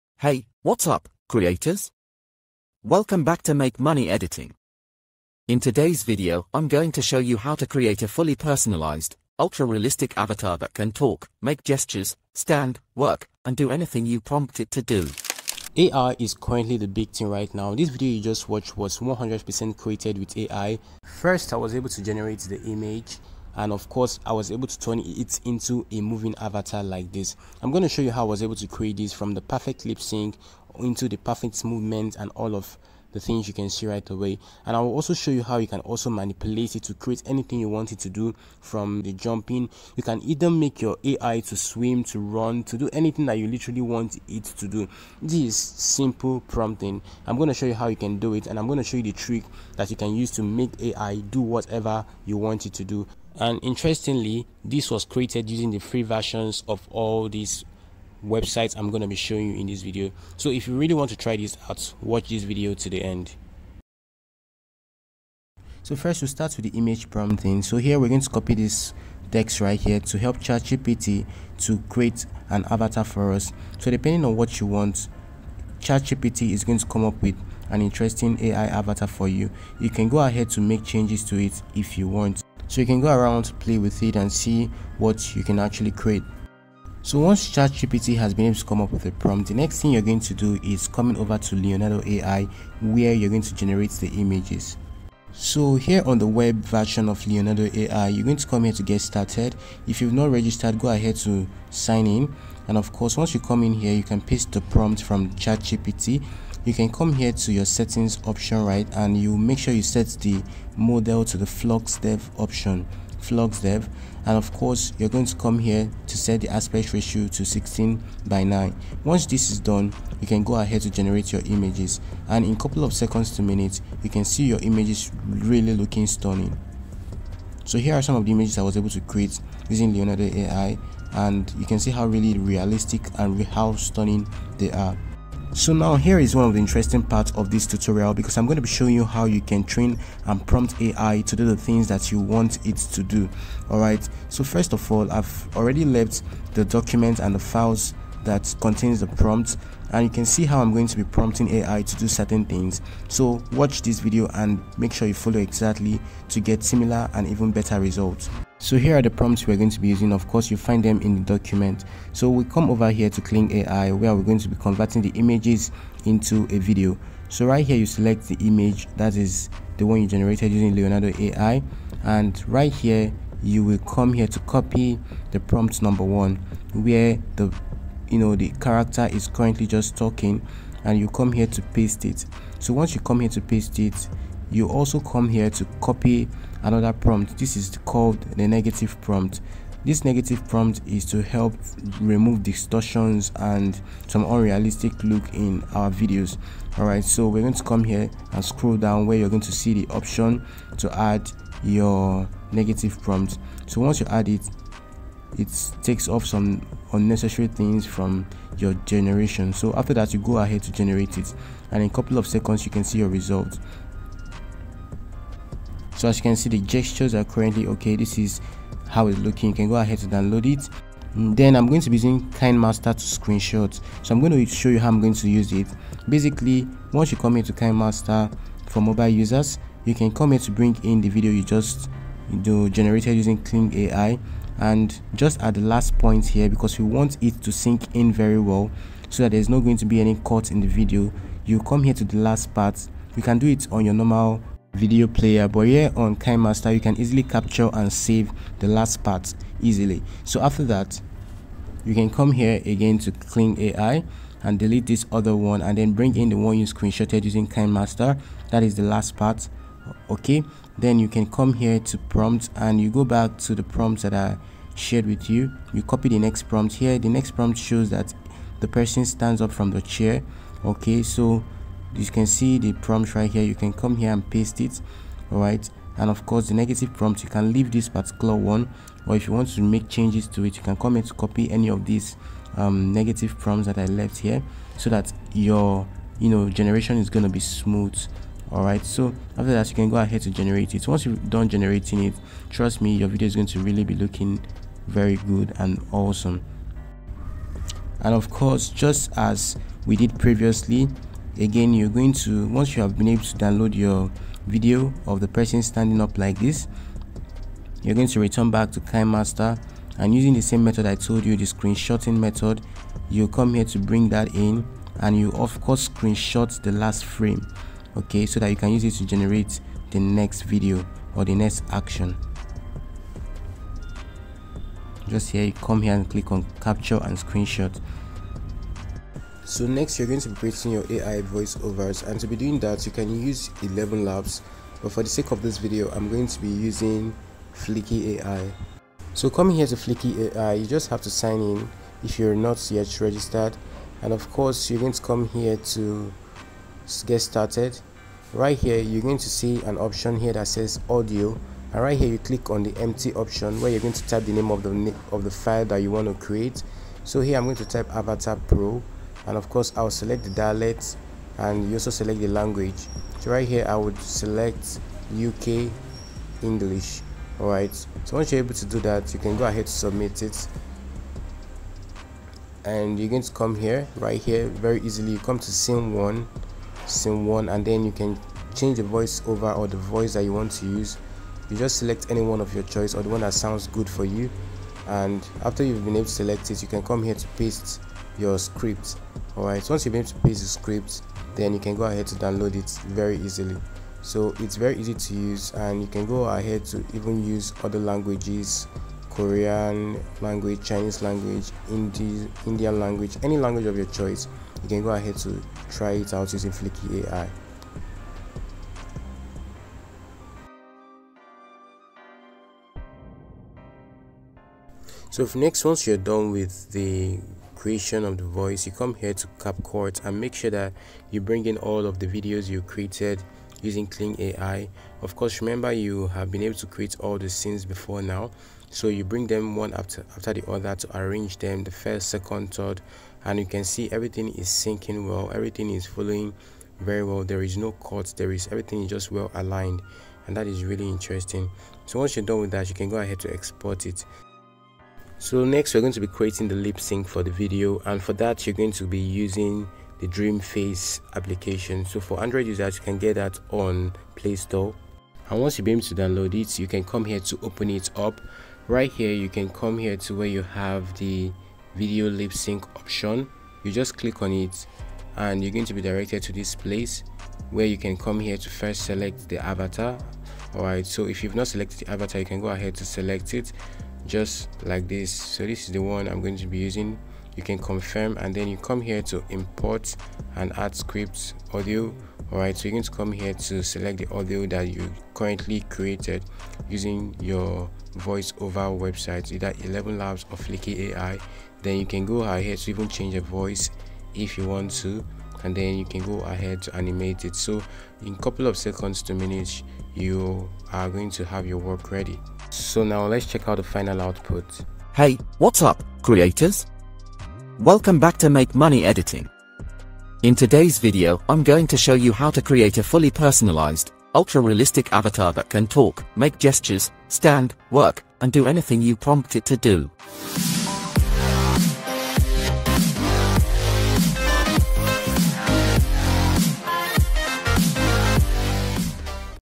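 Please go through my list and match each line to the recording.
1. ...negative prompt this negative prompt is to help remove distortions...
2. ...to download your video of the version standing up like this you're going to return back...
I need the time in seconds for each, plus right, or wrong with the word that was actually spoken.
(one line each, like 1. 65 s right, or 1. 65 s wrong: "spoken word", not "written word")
1. 188 s right
2. 303 s wrong: "person", not "version".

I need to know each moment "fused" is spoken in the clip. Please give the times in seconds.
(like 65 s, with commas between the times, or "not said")
not said.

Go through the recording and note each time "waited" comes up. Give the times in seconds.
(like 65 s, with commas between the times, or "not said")
not said.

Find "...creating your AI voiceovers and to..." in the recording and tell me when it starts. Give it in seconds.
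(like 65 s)
330 s.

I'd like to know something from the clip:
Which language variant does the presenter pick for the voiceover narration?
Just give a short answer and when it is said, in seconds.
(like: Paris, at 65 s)
UK English, at 365 s.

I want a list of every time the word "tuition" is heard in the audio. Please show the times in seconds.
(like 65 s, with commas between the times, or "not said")
not said.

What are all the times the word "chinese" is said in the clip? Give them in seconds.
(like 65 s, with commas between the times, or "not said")
400 s.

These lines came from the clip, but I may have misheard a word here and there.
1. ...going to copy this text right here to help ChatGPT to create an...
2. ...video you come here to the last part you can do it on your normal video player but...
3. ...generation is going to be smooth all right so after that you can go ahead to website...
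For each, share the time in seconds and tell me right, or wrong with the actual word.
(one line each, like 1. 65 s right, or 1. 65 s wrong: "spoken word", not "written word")
1. 68 s right
2. 240 s right
3. 286 s wrong: "generate", not "website".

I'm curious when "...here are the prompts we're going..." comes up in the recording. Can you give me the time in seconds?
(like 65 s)
158 s.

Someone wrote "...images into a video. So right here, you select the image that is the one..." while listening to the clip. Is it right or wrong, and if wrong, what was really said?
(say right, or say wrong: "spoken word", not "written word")
right.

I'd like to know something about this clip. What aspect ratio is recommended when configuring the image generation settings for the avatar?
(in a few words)
16 by 9.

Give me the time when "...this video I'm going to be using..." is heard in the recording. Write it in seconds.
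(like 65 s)
335 s.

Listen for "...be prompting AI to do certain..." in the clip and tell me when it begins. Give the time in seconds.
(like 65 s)
150 s.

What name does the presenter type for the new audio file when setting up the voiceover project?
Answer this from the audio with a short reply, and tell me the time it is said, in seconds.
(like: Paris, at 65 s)
Avatar Pro, at 357 s.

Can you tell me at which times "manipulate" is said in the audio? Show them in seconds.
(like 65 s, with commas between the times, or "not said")
36 s.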